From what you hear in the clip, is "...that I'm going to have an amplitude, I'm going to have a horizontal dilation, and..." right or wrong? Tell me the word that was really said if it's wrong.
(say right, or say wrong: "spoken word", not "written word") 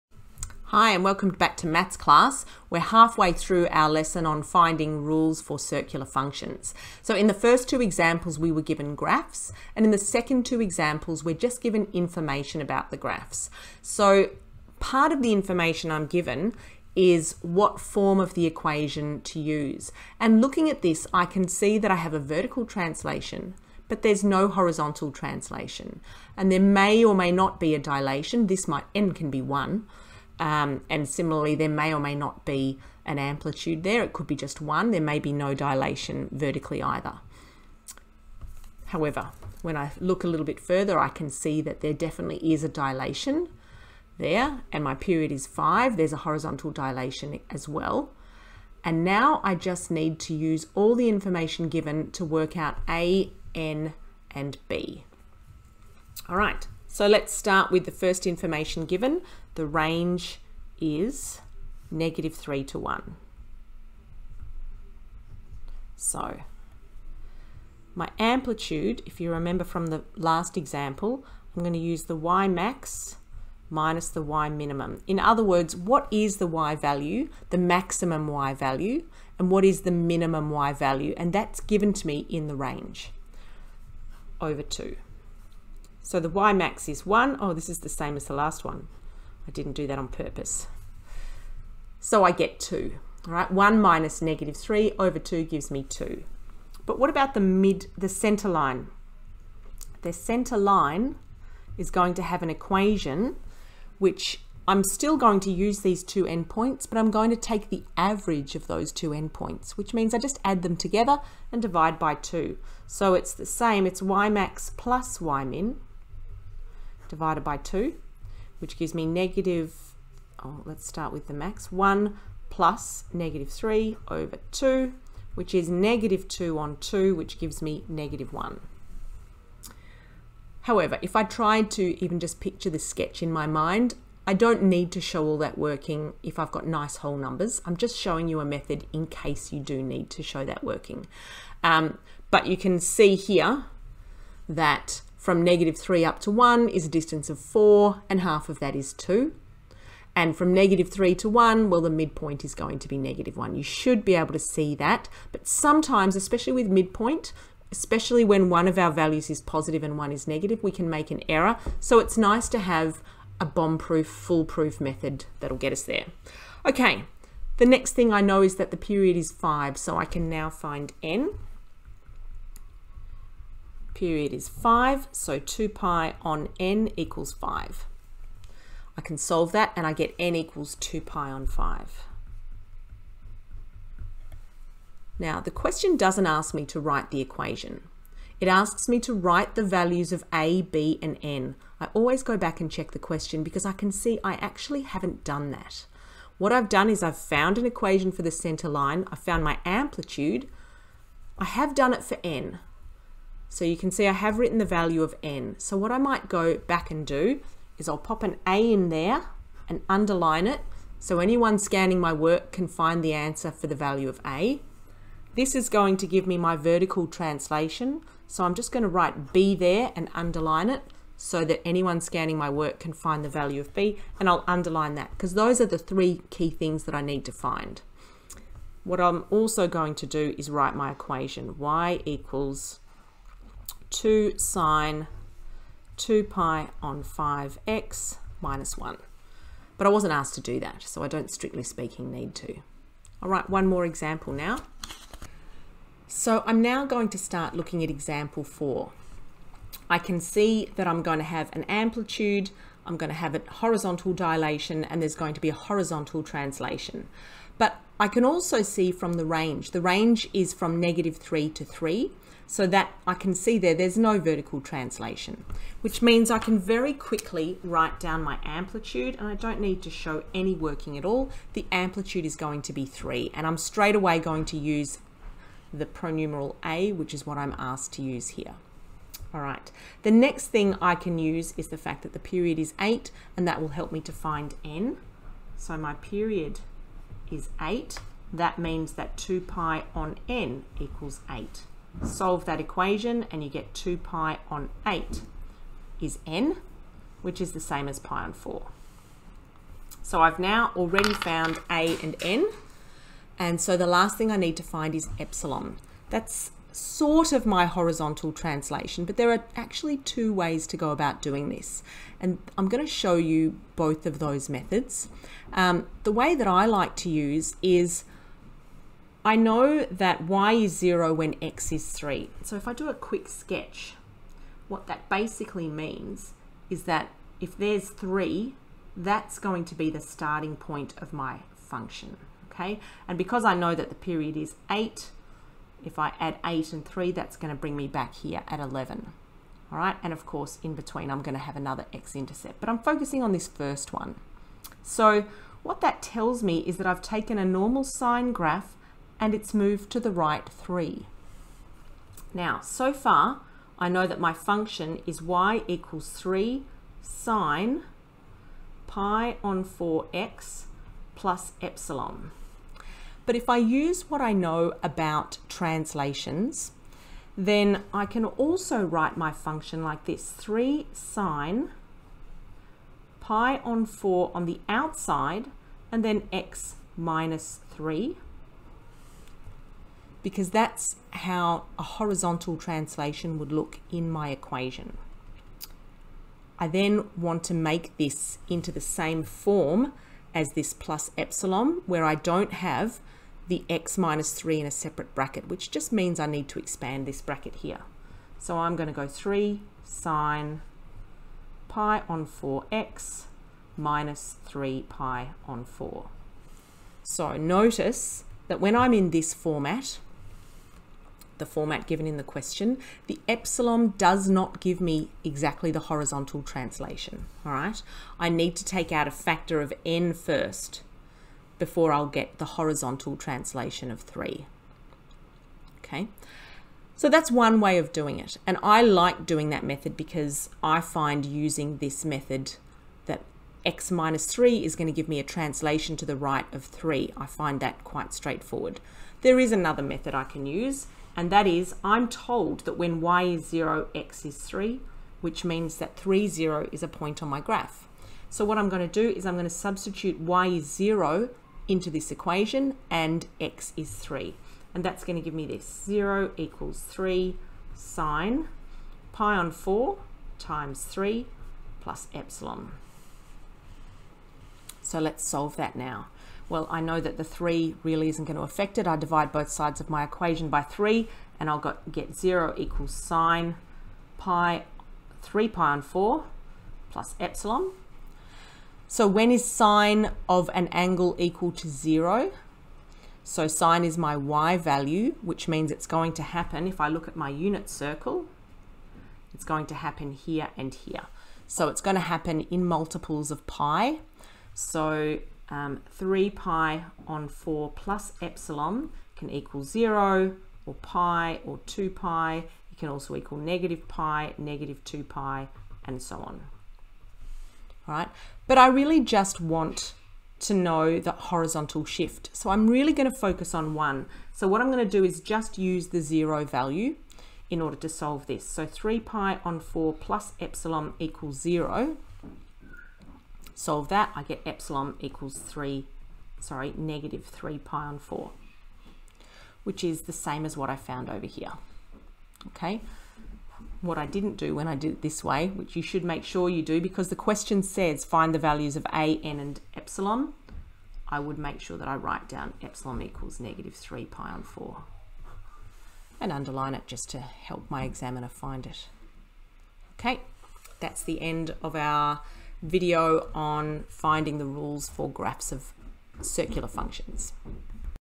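right.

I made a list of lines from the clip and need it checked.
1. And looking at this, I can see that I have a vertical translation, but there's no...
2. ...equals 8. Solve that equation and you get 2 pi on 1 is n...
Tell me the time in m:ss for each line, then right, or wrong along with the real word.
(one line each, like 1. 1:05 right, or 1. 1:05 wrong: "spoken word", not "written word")
1. 0:20 right
2. 4:50 wrong: "8", not "1".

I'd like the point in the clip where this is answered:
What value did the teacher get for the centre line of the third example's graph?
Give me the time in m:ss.
2:07.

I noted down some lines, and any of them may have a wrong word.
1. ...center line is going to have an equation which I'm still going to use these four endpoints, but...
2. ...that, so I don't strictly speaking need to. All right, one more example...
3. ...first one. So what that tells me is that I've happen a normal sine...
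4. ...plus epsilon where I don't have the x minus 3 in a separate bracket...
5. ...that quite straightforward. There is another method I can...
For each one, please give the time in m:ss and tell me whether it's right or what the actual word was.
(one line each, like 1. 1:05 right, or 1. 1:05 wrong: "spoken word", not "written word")
1. 1:40 wrong: "two", not "four"
2. 4:00 right
3. 5:43 wrong: "taken", not "happen"
4. 6:30 right
5. 7:17 right.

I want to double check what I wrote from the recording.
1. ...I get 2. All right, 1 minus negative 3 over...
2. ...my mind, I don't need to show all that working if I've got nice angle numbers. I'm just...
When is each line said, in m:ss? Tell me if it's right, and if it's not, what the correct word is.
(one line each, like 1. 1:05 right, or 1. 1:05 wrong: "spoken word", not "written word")
1. 1:32 right
2. 2:13 wrong: "whole", not "angle".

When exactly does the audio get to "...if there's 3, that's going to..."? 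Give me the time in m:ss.
5:27.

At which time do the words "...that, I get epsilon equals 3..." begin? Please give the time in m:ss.
8:43.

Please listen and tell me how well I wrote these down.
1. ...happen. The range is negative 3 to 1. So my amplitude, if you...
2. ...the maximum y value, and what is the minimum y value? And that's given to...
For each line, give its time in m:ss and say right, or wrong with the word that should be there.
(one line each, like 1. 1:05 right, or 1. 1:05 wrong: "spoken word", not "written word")
1. 0:58 wrong: "given", not "happen"
2. 1:17 right.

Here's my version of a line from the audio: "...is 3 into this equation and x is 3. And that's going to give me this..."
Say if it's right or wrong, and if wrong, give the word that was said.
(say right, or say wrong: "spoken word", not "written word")
wrong: "0", not "3".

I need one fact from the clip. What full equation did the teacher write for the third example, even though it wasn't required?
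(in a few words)
y = 2 sin(2π/5 x) − 1.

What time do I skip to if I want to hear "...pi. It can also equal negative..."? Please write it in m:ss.
8:21.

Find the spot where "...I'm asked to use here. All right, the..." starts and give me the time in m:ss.
4:37.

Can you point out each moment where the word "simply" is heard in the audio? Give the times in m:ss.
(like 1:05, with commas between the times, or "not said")
not said.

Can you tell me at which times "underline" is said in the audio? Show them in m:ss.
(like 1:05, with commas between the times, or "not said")
3:29, 3:40, 3:44, 9:06.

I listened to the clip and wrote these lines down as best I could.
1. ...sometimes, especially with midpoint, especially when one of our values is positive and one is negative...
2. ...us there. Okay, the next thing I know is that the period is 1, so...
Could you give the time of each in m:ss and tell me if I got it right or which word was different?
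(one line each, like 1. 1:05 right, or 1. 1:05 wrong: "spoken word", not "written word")
1. 2:35 right
2. 2:45 wrong: "5", not "1".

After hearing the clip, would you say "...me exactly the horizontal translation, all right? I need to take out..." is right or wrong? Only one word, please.
right.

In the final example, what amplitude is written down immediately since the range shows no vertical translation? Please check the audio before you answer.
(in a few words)
3.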